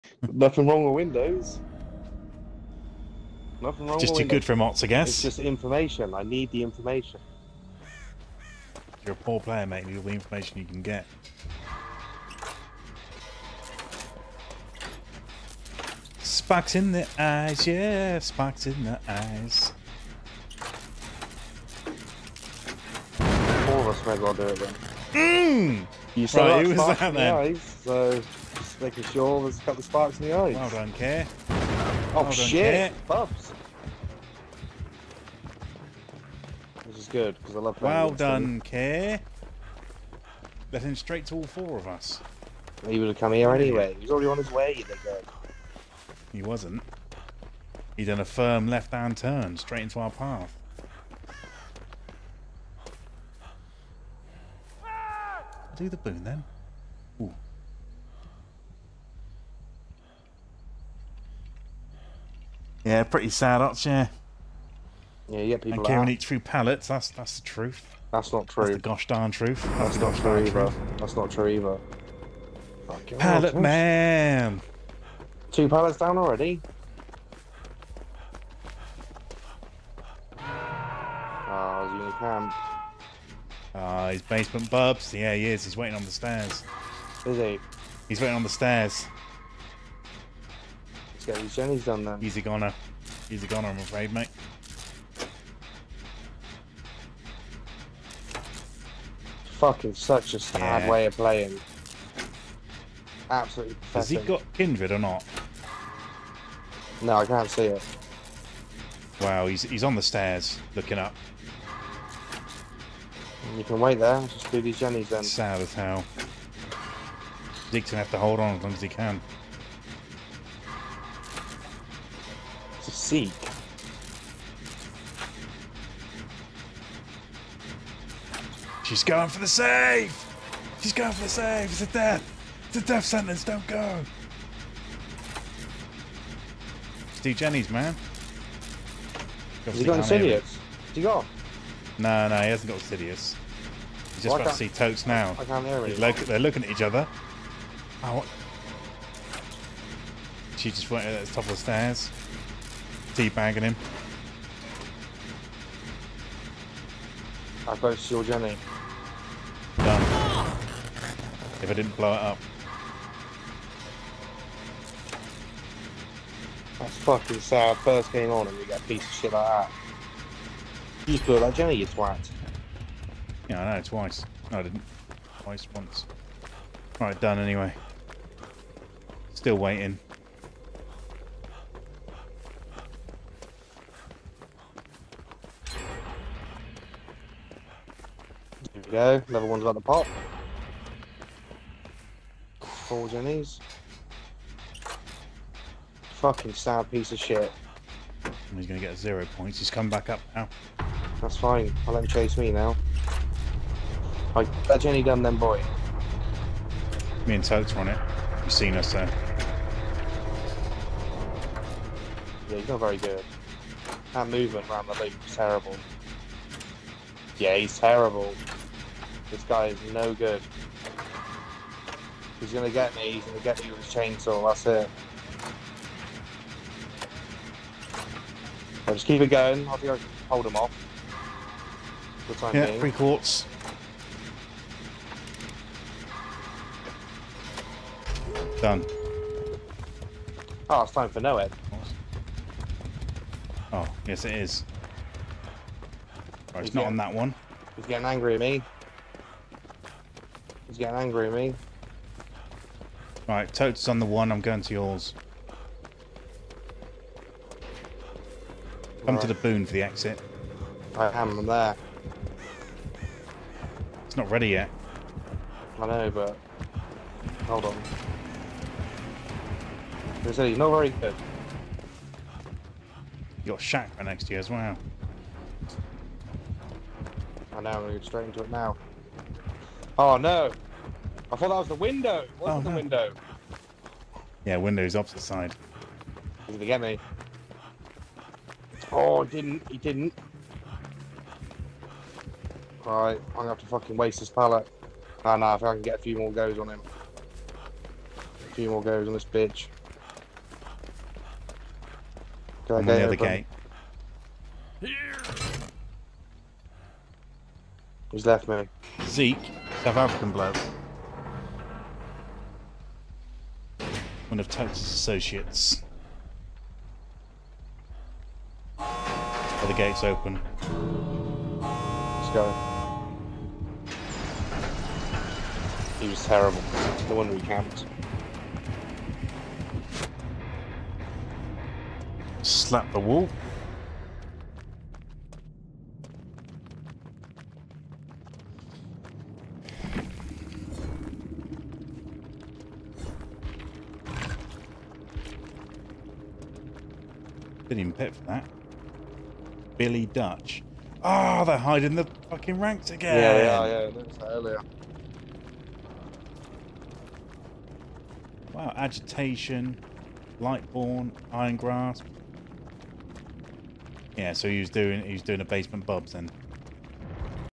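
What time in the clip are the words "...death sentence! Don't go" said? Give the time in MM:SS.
02:12.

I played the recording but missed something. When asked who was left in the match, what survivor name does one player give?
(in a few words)
Zeke.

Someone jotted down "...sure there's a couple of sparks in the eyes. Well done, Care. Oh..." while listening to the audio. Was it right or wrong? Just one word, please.
right.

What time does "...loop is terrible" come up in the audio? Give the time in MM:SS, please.
03:35.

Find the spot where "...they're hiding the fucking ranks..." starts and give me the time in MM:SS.
05:51.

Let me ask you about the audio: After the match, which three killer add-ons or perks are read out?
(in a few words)
Agitation, Lightborn, Iron Grasp.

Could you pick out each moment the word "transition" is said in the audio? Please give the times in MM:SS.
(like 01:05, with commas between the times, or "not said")
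not said.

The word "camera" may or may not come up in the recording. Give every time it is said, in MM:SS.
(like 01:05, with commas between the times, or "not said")
not said.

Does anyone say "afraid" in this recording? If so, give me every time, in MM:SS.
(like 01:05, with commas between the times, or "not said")
01:33.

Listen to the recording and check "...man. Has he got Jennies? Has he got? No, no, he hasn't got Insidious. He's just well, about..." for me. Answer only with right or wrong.
wrong.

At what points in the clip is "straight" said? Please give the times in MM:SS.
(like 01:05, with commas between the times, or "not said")
00:40, 00:49, 04:38.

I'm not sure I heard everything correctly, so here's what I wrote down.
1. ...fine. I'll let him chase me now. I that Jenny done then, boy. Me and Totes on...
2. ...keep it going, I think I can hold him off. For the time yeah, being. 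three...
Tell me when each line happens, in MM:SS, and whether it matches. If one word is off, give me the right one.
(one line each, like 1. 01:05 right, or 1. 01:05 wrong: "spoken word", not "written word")
1. 03:21 right
2. 03:49 right.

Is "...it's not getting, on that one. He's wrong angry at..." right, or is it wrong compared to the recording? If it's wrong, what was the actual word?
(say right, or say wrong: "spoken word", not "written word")
wrong: "getting", not "wrong".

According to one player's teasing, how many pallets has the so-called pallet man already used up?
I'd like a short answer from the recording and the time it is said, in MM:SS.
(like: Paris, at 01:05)
2, at 01:15.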